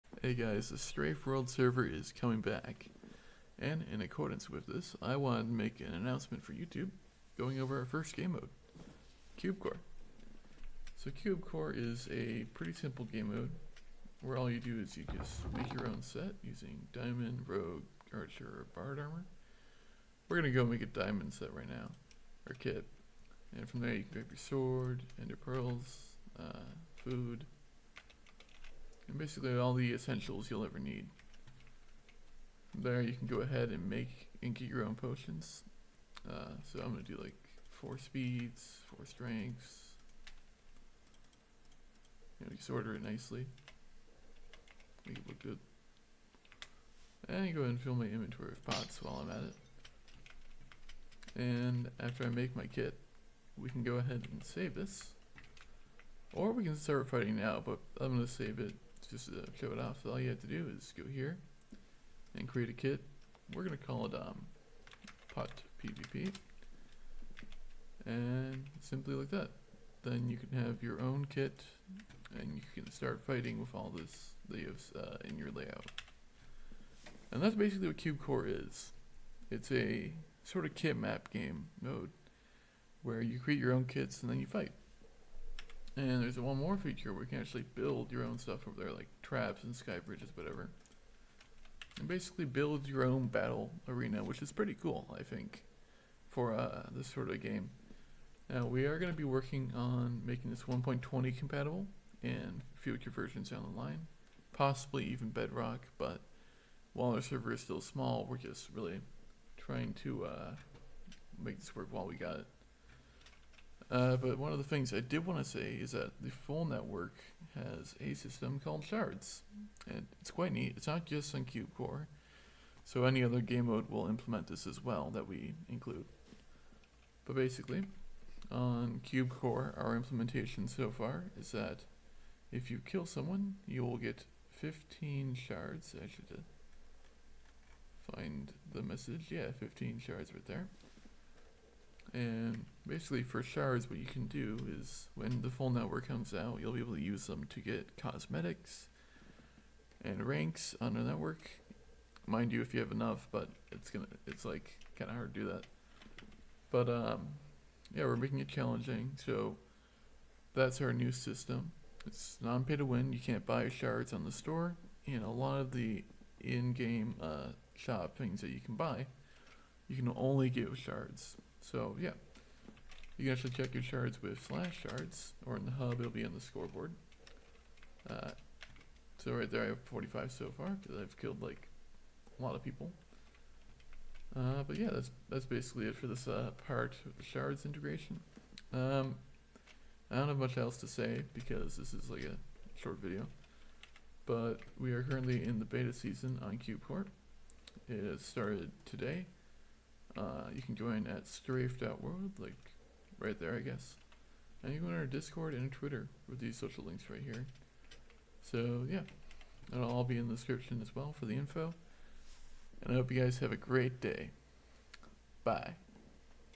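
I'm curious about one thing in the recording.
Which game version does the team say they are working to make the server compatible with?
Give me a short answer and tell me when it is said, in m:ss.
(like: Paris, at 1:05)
1.20, at 1:40.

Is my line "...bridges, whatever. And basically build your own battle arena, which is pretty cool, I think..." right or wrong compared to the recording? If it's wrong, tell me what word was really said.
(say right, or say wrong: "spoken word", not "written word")
right.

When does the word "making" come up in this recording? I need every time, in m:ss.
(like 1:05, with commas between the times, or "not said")
1:40, 2:38.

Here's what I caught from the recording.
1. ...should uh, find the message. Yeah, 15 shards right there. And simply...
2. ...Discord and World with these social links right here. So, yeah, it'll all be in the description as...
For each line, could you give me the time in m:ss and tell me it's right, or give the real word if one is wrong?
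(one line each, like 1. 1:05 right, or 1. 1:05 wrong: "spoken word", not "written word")
1. 2:16 wrong: "basically", not "simply"
2. 3:25 wrong: "Twitter", not "World".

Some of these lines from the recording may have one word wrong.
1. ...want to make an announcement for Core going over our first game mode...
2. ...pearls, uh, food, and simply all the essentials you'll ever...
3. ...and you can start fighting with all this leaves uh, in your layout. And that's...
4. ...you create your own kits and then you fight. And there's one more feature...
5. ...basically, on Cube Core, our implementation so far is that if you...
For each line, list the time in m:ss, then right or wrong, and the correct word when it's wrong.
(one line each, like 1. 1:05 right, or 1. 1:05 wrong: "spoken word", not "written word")
1. 0:05 wrong: "YouTube", not "Core"
2. 0:25 wrong: "basically", not "simply"
3. 1:12 right
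4. 1:23 right
5. 2:07 right.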